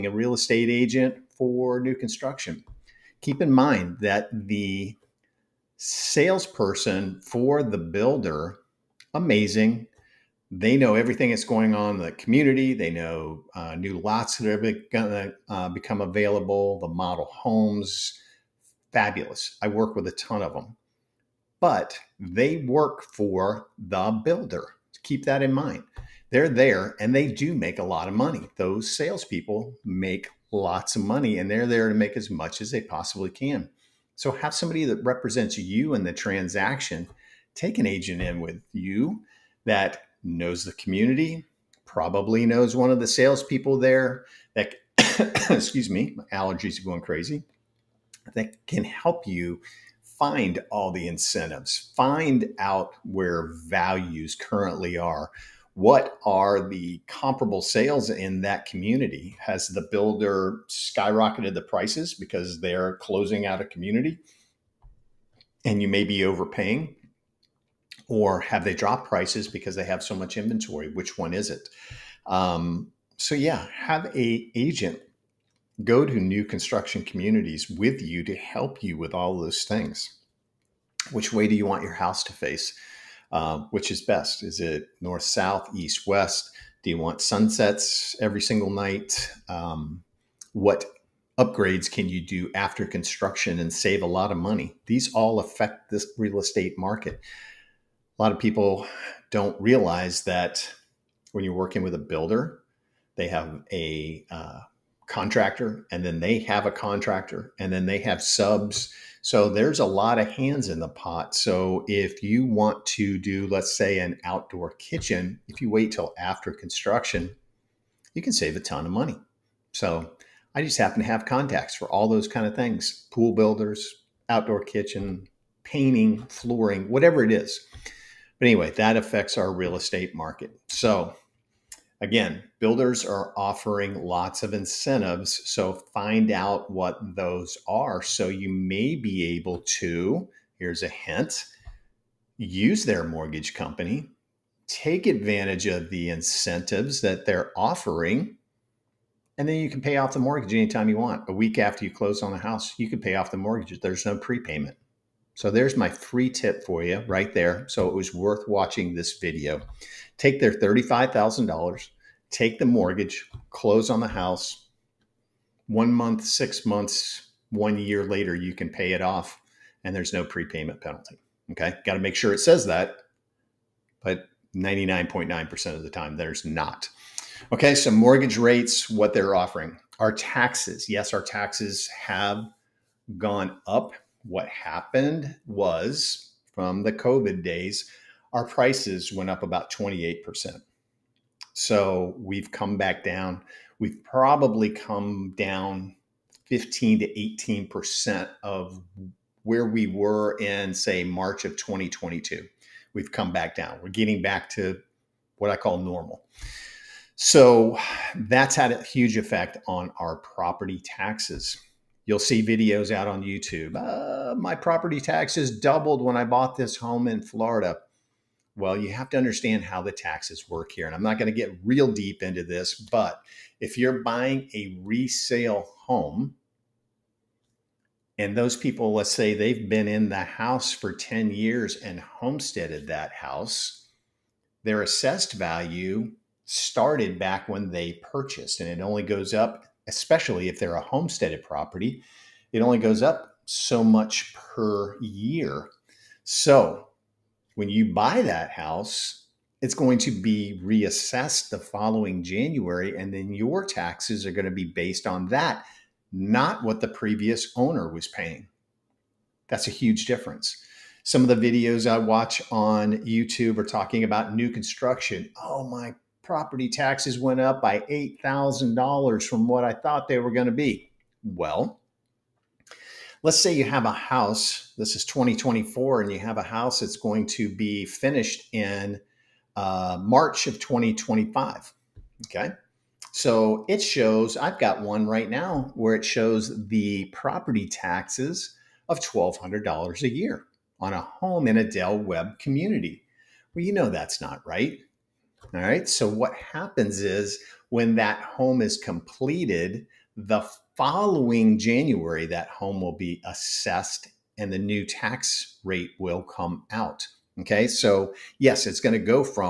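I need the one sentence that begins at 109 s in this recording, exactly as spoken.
So there's a lot of hands in the pot.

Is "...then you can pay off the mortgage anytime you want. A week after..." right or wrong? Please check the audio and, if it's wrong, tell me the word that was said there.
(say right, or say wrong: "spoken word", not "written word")
right.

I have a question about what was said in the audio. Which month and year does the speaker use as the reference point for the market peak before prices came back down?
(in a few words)
March 2022.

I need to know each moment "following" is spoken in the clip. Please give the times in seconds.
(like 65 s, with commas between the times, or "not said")
251 s, 300 s.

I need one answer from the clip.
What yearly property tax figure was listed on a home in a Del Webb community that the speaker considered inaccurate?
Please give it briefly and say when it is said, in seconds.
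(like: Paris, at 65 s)
$1,200, at 288 s.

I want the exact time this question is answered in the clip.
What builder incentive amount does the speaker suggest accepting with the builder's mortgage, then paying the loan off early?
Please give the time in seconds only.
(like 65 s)
160 s.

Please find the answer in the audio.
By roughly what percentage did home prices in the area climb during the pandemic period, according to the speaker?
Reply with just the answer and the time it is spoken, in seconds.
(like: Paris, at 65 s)
28%, at 189 s.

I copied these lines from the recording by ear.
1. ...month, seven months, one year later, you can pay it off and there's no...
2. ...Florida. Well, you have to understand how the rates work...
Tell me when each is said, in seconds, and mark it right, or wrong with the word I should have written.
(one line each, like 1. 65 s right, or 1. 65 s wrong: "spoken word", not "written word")
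1. 165 s wrong: "six", not "seven"
2. 217 s wrong: "taxes", not "rates".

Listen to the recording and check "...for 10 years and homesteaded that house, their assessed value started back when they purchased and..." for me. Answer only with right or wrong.
right.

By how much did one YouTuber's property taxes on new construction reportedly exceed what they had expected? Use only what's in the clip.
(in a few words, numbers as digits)
$8,000.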